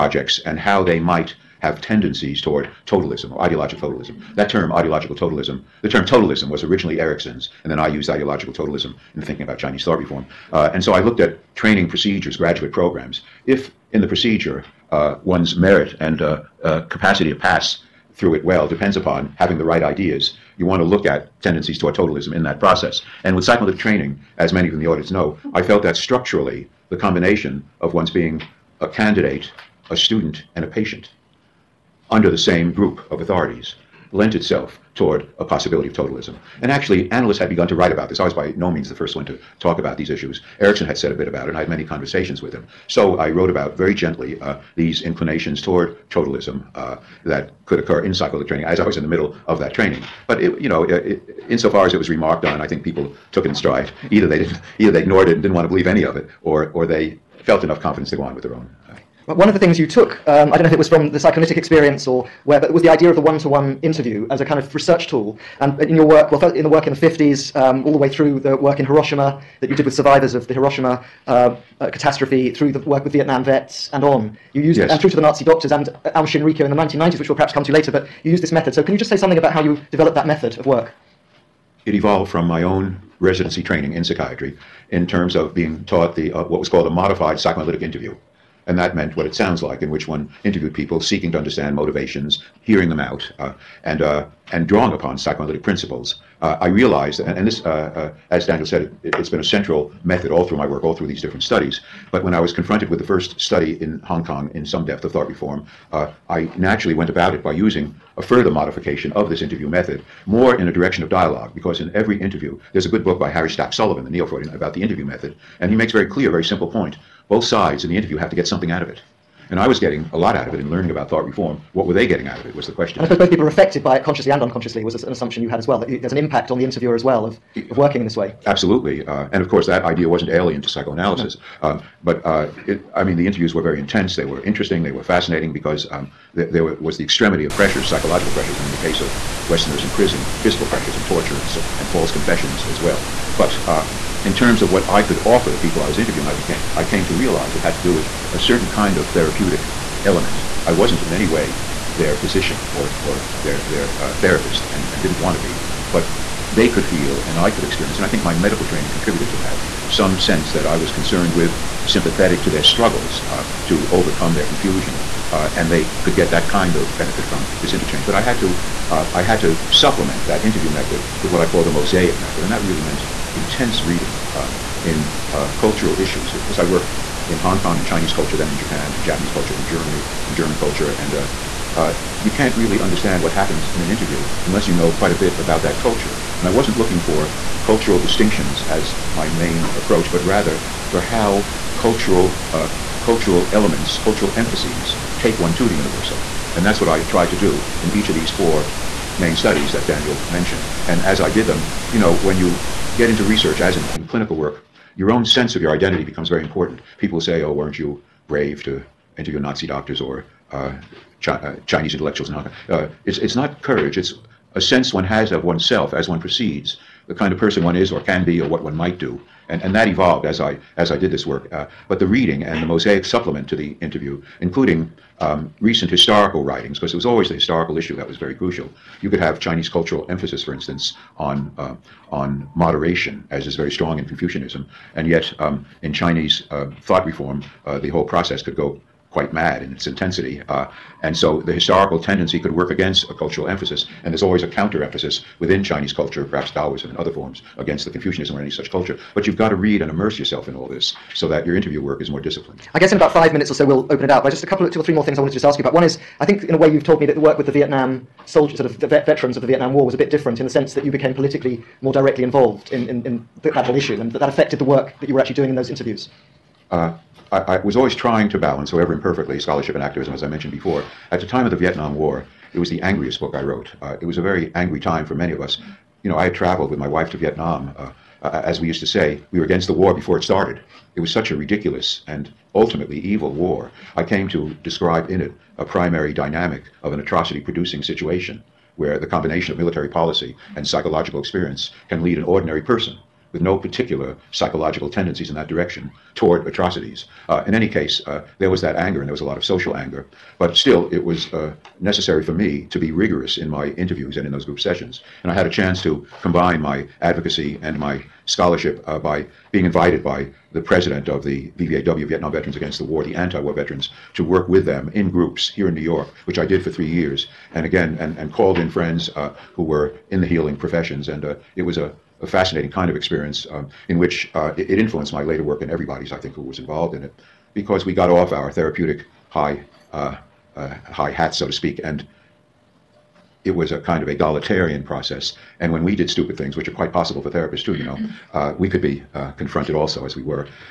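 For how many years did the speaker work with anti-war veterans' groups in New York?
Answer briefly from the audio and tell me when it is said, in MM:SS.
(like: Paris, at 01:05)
3 years, at 05:16.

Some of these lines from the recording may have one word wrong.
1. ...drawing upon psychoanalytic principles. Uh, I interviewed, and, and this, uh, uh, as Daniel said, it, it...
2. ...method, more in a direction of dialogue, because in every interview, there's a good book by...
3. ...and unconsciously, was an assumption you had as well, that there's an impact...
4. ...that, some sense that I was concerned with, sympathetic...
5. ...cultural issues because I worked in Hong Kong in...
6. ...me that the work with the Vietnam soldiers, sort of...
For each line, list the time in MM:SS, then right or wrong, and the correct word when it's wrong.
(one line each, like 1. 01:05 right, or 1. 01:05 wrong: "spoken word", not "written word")
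1. 01:34 wrong: "realized", not "interviewed"
2. 01:49 right
3. 02:04 right
4. 02:39 right
5. 02:55 right
6. 04:16 right.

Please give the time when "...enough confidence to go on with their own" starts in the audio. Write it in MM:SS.
00:57.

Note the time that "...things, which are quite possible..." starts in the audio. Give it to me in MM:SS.
05:36.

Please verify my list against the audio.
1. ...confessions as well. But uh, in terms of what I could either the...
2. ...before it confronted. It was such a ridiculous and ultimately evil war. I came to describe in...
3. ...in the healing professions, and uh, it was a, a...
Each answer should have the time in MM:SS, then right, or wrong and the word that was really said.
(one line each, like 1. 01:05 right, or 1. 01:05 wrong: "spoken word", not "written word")
1. 02:22 wrong: "offer", not "either"
2. 04:39 wrong: "started", not "confronted"
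3. 05:20 right.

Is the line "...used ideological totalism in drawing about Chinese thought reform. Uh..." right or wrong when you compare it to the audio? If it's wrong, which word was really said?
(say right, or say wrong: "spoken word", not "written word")
wrong: "thinking", not "drawing".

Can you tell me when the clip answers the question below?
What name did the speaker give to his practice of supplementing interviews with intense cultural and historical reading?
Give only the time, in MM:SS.
02:51.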